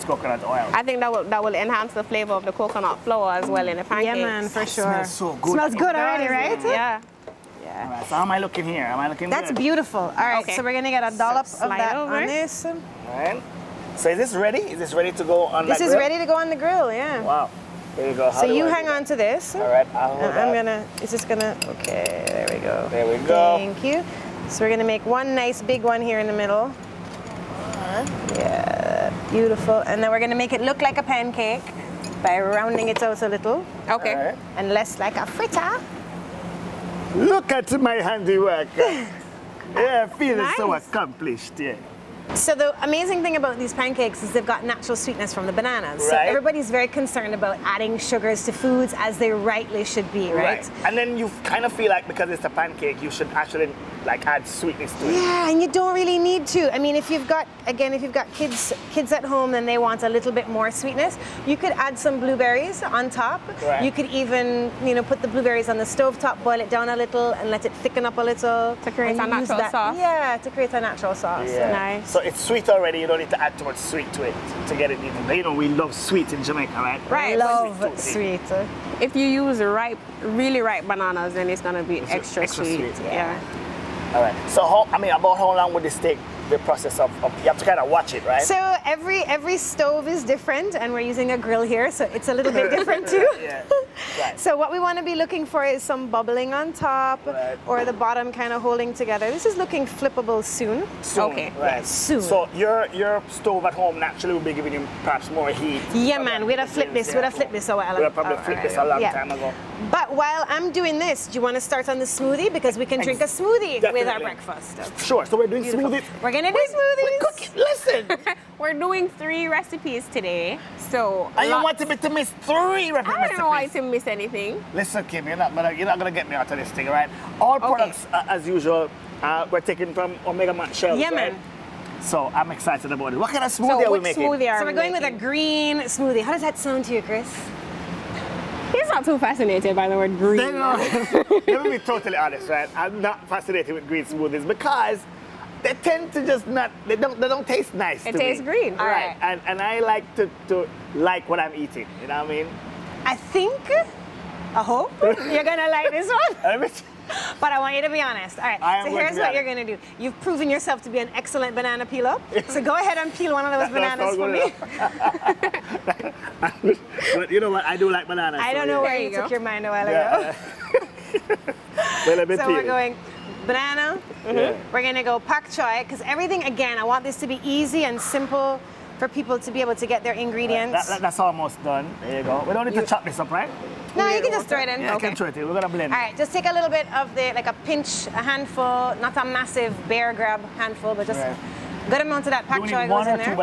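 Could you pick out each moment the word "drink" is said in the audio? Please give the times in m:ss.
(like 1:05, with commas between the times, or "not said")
1:53.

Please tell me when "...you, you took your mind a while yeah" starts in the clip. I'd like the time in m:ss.
2:48.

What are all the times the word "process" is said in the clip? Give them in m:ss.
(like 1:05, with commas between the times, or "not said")
1:26.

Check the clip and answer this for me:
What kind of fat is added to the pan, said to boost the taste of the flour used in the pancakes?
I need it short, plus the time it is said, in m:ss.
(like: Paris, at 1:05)
coconut oil, at 0:00.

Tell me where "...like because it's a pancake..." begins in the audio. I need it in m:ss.
0:51.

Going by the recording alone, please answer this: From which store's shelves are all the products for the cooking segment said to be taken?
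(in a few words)
Mega Mart.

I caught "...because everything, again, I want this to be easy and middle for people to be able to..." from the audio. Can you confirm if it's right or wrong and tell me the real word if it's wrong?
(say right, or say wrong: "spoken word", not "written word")
wrong: "simple", not "middle".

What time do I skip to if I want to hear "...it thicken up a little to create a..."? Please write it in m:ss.
1:07.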